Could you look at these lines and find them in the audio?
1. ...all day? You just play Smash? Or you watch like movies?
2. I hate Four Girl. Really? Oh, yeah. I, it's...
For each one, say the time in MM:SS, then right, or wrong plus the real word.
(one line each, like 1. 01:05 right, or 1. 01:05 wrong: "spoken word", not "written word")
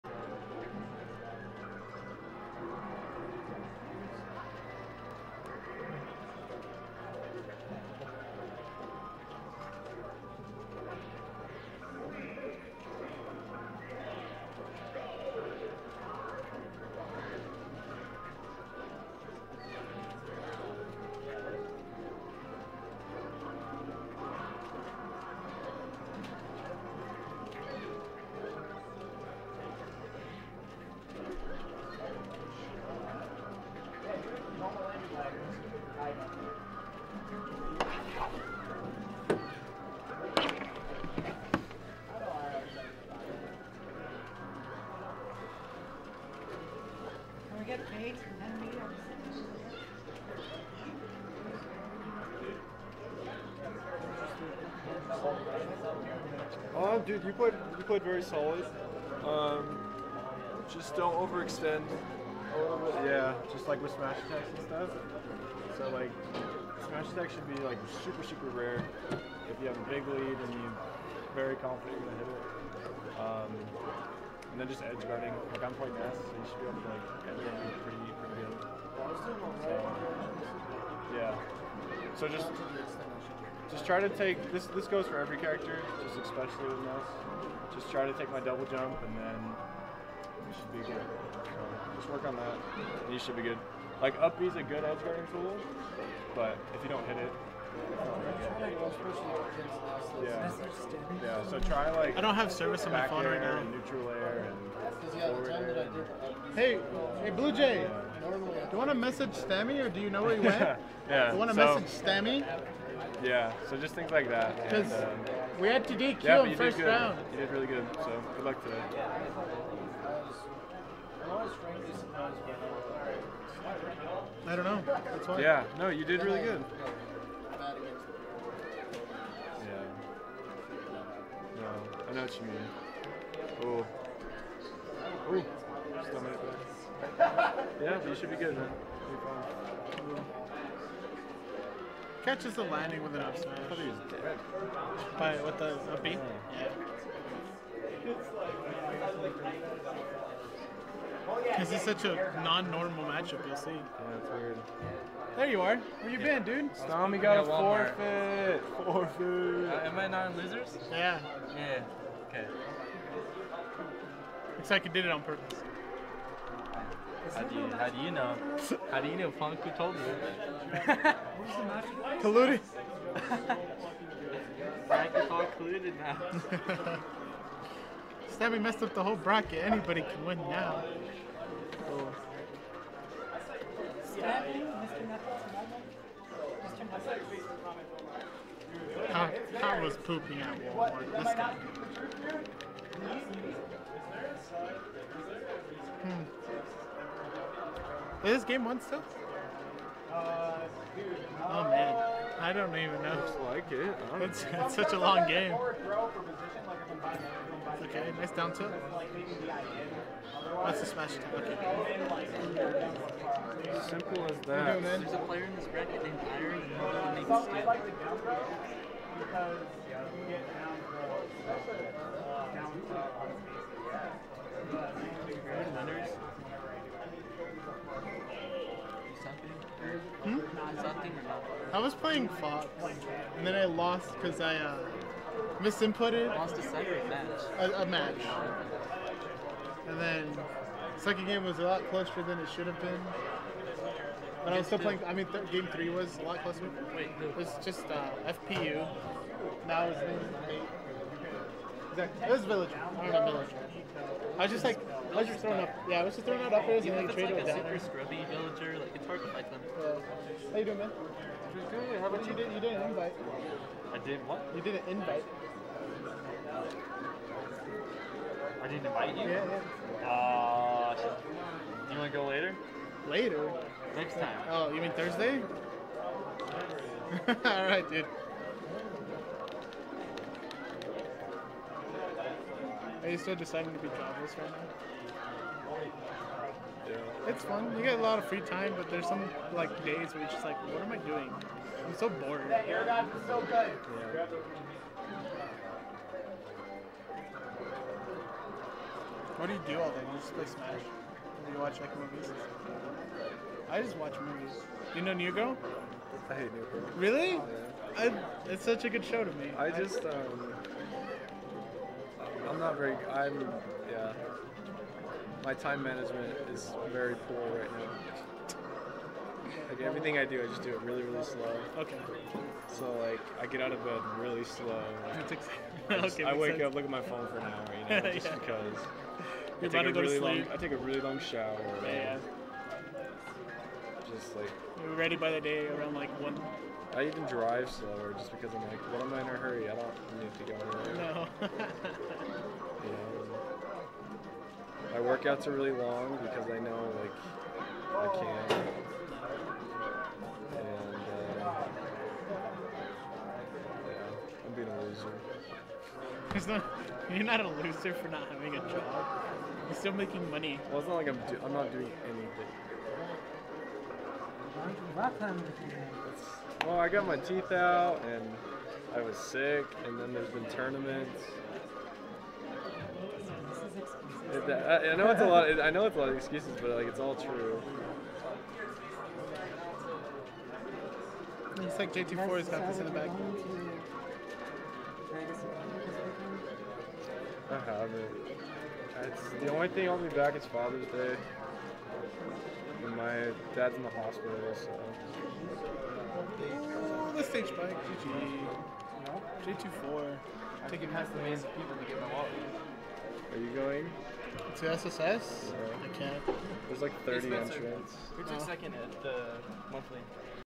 1. 04:59 right
2. 05:06 wrong: "New", not "Four".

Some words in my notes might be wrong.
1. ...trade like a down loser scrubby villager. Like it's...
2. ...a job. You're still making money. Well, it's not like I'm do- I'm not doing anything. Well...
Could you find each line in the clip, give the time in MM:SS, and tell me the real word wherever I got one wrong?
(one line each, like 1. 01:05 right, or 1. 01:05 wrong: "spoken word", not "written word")
1. 04:17 wrong: "super", not "loser"
2. 05:58 right.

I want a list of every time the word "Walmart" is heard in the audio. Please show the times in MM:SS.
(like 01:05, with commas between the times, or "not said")
03:10.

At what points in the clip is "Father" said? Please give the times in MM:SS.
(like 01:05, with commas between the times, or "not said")
06:30.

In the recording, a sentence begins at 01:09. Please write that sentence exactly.
If you have a big lead and you're very confident you're gonna hit it.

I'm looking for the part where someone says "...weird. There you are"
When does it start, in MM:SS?
02:34.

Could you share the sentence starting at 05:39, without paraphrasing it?
I don't need to go anywhere.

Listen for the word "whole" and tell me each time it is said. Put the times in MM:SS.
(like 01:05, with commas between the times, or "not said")
02:59.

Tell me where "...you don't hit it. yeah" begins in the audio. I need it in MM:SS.
01:36.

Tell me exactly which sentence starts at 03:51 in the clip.
I was playing Fox, and then I lost because I uh, misinputted.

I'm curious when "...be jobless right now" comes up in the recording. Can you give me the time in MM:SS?
04:43.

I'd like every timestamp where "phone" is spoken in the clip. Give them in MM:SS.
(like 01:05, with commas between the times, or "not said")
01:43, 05:27.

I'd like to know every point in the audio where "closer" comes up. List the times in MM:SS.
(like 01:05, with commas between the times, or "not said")
04:01, 04:06.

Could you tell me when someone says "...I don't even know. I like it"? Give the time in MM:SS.
03:22.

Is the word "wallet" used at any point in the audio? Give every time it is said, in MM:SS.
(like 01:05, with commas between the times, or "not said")
06:42.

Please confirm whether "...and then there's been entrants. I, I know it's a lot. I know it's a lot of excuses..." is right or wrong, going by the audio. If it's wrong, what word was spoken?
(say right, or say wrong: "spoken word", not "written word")
wrong: "tournaments", not "entrants".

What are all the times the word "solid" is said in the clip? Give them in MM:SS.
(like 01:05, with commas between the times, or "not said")
00:58.